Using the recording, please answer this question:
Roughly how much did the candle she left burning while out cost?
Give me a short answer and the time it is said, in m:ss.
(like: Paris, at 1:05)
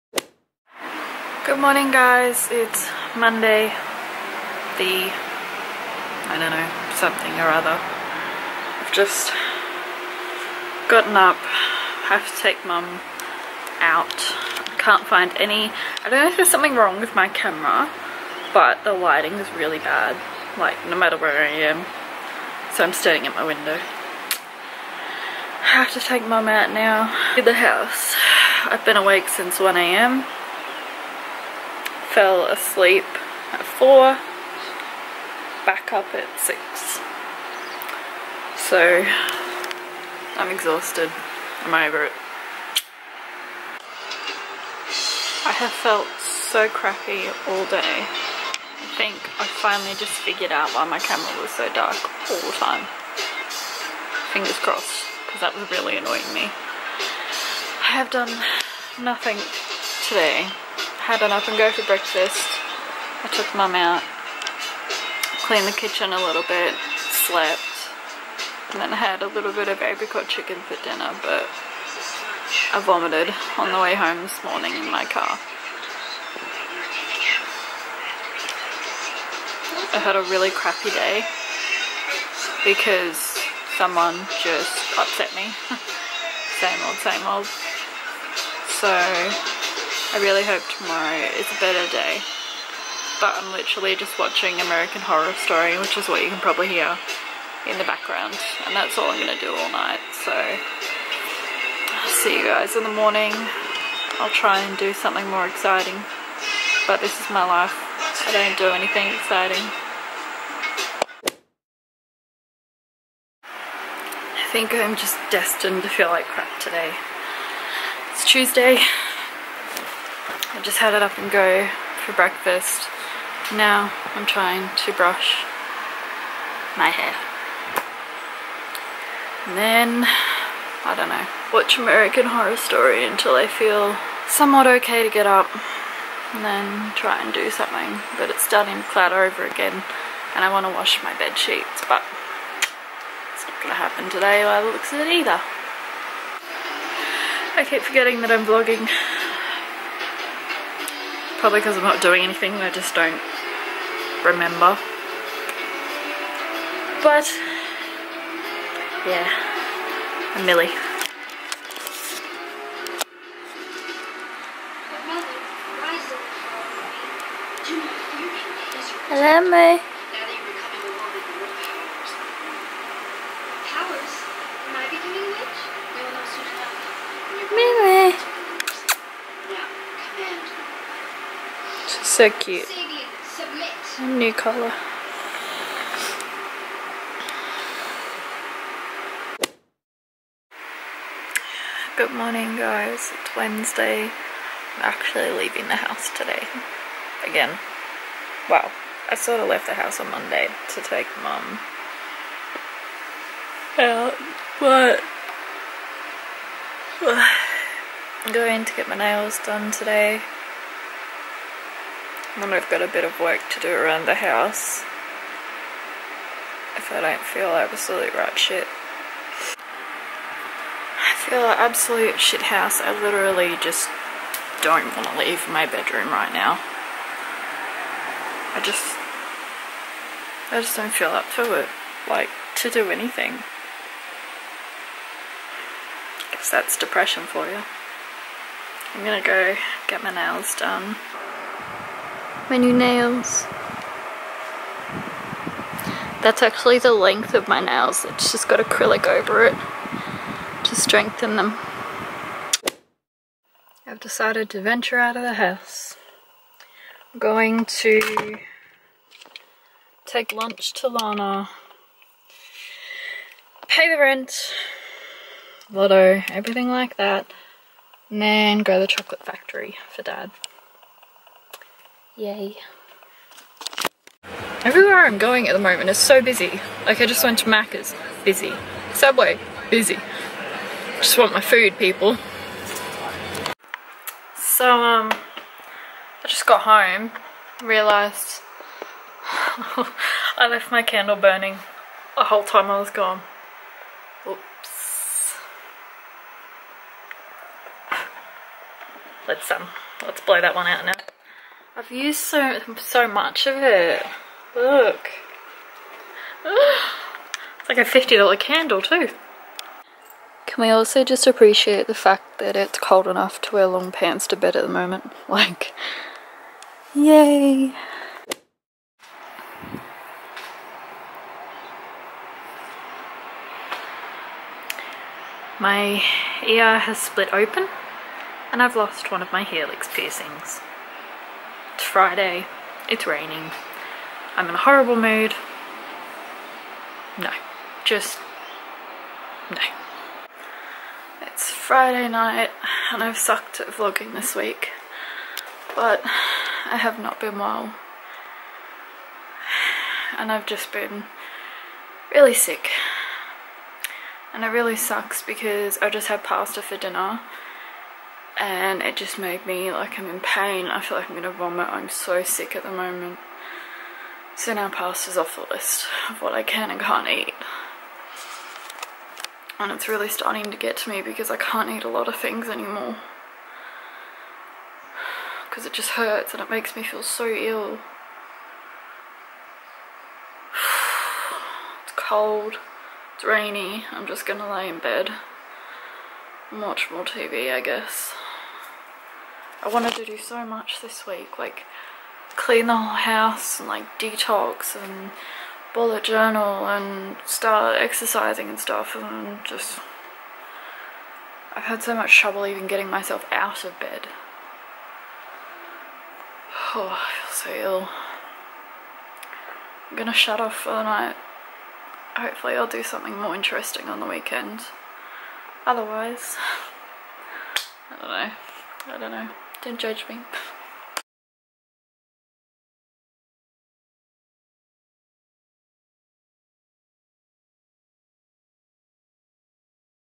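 $50, at 5:07.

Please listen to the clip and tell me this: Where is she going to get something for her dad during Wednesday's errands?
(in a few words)
the chocolate factory.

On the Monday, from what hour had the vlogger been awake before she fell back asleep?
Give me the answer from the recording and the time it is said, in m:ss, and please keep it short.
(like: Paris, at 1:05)
1am, at 0:29.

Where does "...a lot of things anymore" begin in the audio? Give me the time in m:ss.
6:11.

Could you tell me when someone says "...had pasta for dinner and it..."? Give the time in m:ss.
5:56.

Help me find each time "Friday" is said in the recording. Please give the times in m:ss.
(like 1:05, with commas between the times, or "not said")
5:31, 5:41.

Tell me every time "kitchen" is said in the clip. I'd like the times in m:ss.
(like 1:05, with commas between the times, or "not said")
1:05.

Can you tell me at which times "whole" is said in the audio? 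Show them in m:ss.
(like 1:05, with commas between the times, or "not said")
4:52, 6:32.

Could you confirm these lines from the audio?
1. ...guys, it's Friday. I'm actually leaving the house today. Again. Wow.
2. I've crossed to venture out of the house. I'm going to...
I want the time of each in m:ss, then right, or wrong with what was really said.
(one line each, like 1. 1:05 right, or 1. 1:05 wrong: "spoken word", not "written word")
1. 3:12 wrong: "Wednesday", not "Friday"
2. 4:13 wrong: "decided", not "crossed".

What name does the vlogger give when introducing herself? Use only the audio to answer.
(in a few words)
Millie.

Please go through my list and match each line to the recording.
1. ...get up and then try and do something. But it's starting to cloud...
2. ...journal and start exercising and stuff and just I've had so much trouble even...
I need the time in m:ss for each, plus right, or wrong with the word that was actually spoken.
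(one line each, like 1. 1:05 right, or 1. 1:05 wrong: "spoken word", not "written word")
1. 2:15 right
2. 6:36 right.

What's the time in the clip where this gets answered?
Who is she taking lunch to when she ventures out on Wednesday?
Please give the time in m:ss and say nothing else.
4:20.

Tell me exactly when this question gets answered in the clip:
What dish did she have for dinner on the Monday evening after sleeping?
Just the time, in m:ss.
1:09.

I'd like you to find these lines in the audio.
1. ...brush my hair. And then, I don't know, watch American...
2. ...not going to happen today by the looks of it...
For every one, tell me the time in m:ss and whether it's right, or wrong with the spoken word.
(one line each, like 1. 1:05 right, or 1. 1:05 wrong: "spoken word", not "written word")
1. 2:04 right
2. 2:23 right.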